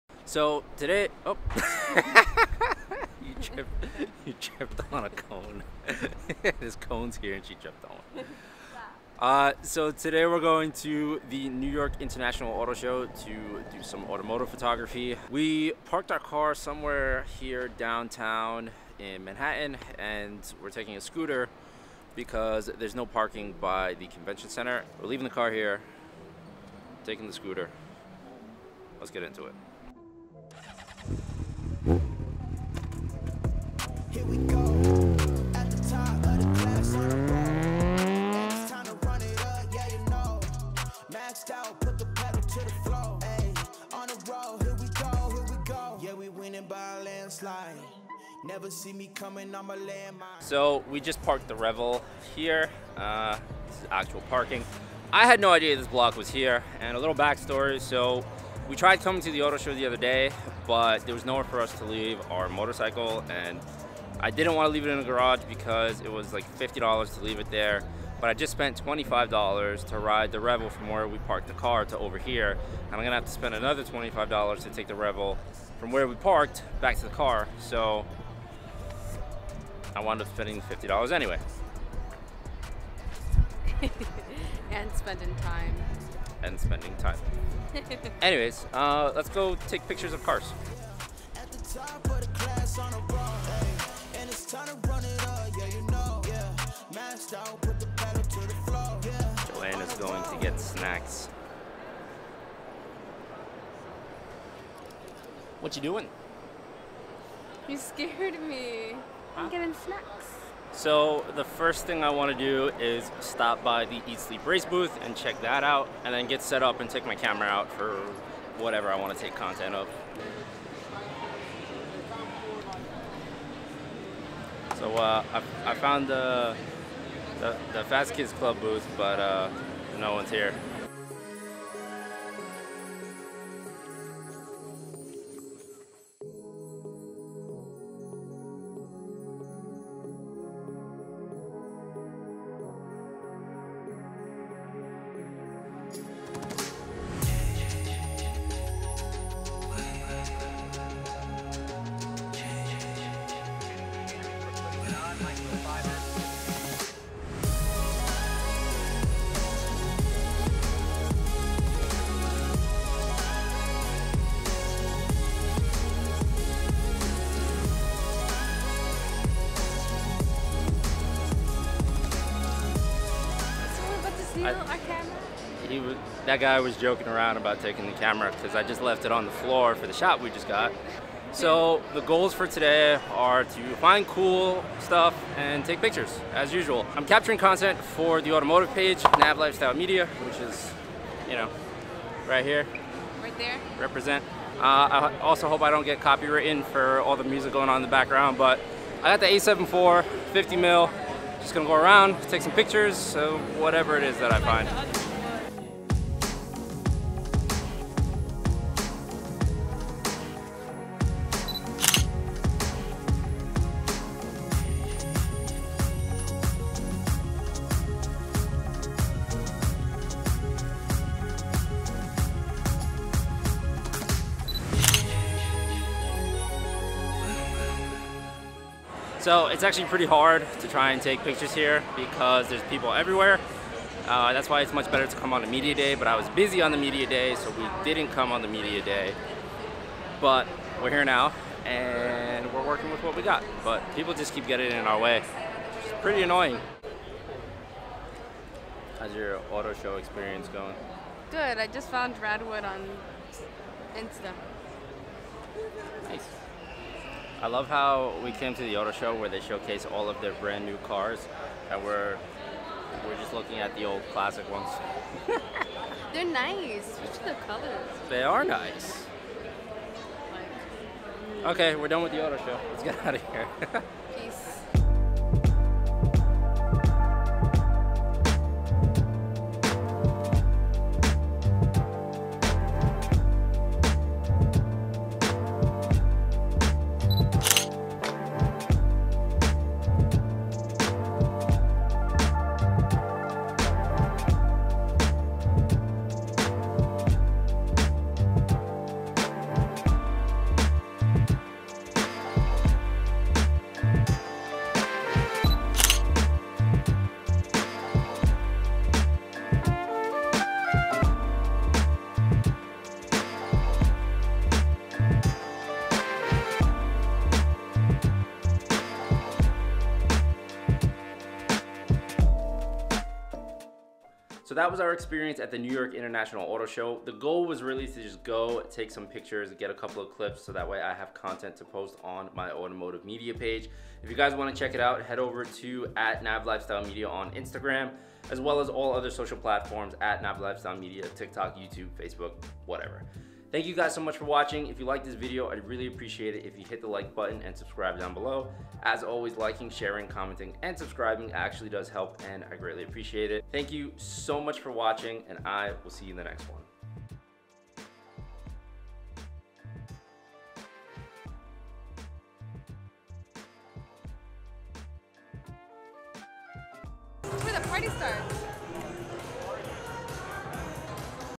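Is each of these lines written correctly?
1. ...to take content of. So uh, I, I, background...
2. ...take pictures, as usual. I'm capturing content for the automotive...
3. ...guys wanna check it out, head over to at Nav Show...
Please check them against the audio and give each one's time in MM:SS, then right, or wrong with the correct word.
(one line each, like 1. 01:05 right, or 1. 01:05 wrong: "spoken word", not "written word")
1. 01:59 wrong: "found", not "background"
2. 03:05 right
3. 05:34 wrong: "Lifestyle", not "Show".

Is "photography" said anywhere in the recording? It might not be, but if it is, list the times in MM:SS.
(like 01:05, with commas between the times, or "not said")
00:14.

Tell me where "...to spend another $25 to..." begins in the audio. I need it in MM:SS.
01:13.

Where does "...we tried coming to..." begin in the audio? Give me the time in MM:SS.
00:58.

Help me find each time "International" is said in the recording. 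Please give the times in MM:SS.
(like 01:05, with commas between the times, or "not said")
00:11, 05:25.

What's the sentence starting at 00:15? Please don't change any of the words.
We parked our car somewhere here downtown in Manhattan and we're taking a scooter because there's no parking by the convention center.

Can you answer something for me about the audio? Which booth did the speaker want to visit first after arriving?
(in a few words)
Eat Sleep Race.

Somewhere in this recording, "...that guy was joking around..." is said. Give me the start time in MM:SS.
02:56.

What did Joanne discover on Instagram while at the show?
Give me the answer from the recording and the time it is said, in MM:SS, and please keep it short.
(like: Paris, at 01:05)
Radwood, at 04:12.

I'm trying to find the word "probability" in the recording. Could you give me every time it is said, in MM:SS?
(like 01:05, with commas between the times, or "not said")
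not said.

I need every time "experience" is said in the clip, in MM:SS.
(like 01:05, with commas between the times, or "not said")
04:09, 05:24.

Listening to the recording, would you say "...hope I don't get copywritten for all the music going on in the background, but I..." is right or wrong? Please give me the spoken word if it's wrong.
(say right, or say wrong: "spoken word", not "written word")
right.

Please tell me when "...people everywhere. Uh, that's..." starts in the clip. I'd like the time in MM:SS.
03:52.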